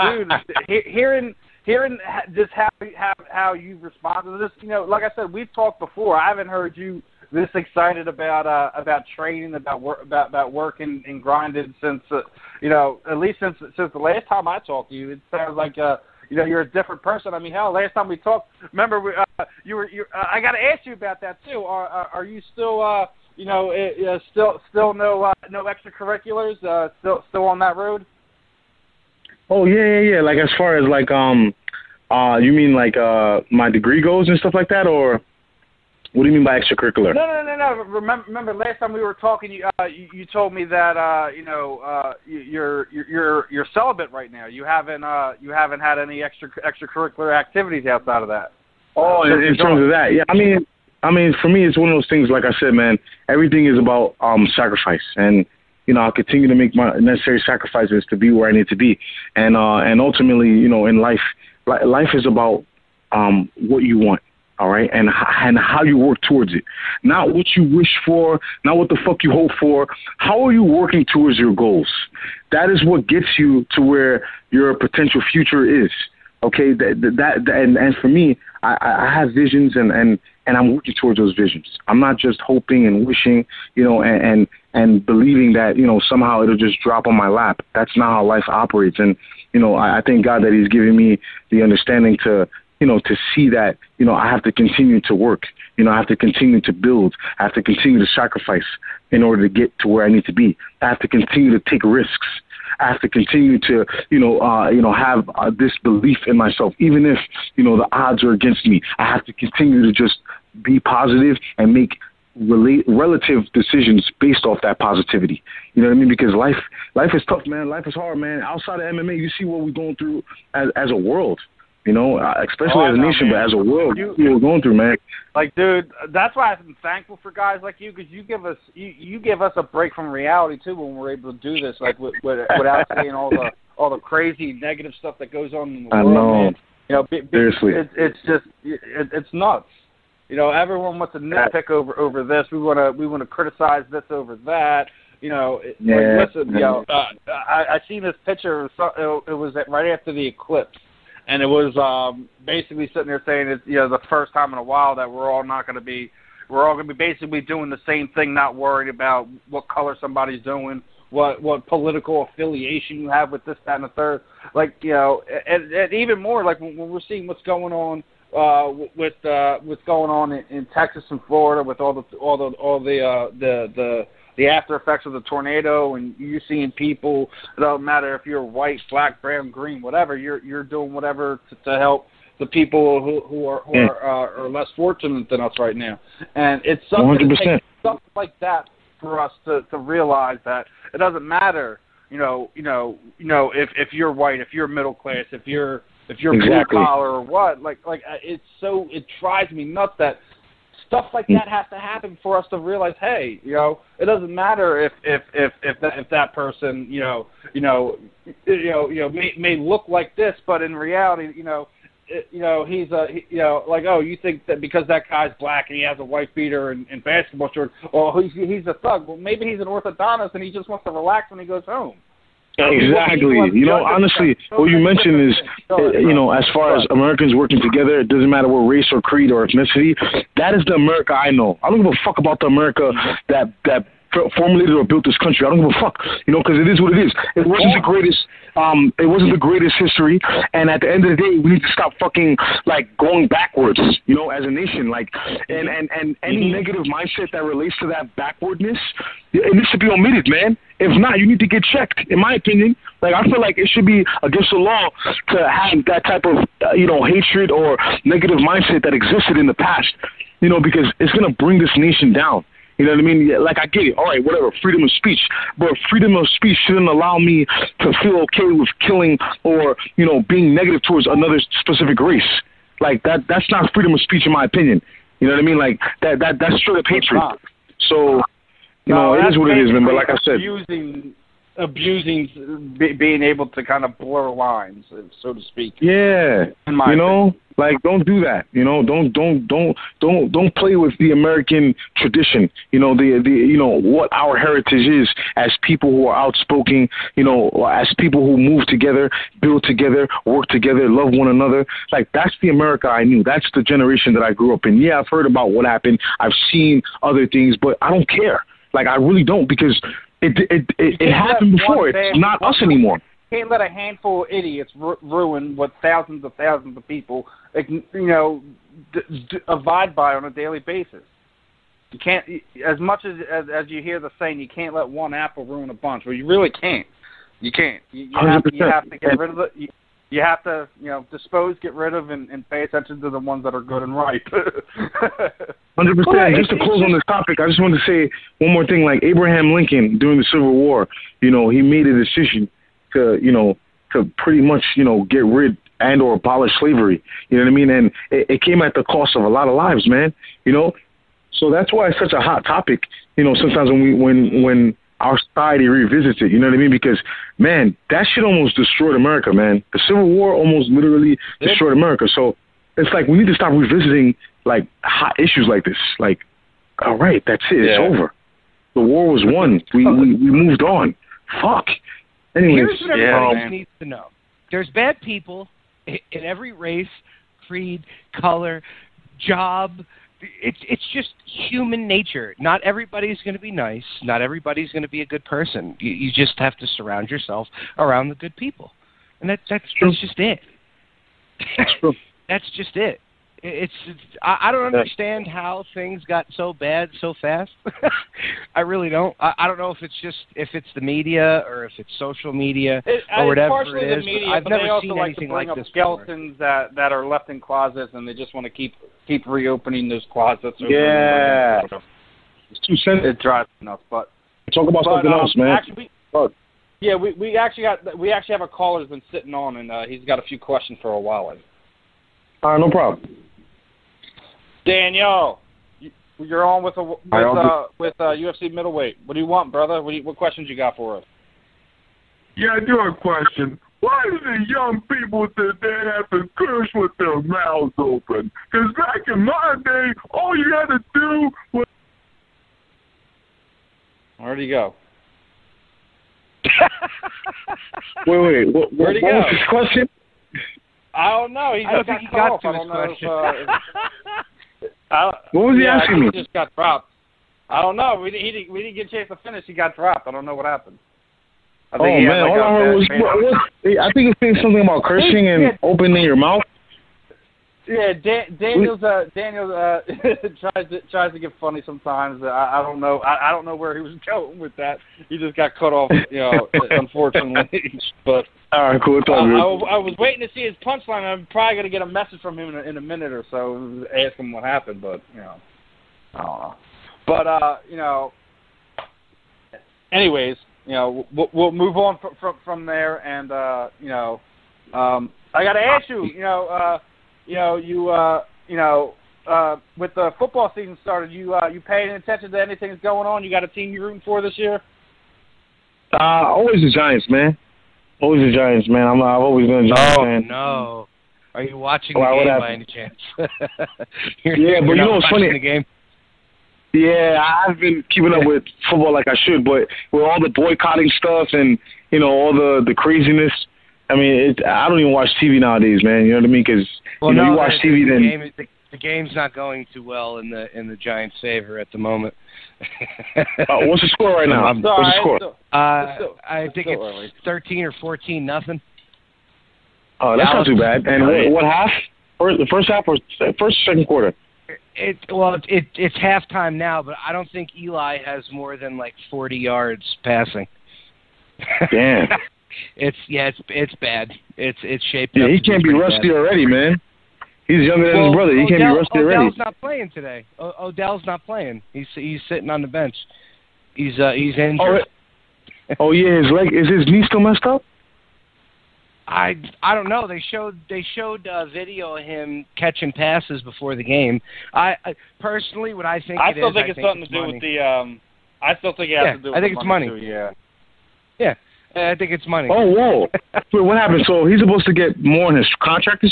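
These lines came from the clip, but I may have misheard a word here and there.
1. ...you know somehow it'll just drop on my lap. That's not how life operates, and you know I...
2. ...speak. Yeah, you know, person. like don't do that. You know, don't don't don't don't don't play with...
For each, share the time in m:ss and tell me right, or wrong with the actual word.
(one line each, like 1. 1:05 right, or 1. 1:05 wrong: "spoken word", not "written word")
1. 1:25 right
2. 4:45 wrong: "opinion", not "person".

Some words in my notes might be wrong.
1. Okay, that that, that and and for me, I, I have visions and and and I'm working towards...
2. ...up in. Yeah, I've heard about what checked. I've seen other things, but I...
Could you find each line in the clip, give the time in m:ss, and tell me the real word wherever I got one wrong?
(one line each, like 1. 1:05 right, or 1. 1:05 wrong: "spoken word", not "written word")
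1. 1:16 right
2. 5:04 wrong: "happened", not "checked".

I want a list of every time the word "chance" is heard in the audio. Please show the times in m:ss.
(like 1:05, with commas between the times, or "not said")
7:38, 8:32.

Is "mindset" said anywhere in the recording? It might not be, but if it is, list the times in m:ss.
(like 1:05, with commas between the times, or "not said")
4:06, 4:18.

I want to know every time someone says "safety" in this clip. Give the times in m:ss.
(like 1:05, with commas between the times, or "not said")
not said.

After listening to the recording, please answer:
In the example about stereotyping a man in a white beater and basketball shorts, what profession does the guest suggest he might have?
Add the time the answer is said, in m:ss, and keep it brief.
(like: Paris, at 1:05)
orthodontist, at 3:39.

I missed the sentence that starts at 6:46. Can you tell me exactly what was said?
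that that are left in closets and they just want to keep keep reopening those closets.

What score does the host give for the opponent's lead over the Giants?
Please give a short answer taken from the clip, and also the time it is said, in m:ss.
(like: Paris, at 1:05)
13 or 14 to nothing, at 8:57.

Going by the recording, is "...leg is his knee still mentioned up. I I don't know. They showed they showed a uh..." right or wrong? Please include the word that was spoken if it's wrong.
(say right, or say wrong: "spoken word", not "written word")
wrong: "messed", not "mentioned".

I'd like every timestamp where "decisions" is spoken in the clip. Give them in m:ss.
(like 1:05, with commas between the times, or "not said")
1:53, 5:41.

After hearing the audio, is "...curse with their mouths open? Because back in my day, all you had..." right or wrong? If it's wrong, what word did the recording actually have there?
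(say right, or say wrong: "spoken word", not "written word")
right.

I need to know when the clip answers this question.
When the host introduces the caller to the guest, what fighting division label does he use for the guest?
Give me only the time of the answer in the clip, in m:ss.
7:08.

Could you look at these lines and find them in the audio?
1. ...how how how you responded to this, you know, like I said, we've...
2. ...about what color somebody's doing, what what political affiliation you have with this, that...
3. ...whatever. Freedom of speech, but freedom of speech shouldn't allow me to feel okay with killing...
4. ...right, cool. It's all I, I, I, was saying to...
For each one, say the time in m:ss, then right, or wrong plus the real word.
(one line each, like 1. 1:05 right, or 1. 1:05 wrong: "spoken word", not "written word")
1. 0:02 right
2. 2:38 right
3. 4:24 right
4. 7:58 wrong: "waiting", not "saying".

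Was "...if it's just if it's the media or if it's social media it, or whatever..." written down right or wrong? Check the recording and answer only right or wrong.
right.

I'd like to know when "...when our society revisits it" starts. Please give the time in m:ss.
5:54.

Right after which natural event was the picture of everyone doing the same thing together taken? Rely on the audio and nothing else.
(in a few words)
the eclipse.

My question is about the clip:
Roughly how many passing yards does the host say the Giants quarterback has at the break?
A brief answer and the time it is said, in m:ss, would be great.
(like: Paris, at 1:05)
40, at 9:09.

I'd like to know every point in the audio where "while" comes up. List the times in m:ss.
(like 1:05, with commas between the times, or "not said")
2:34, 7:00.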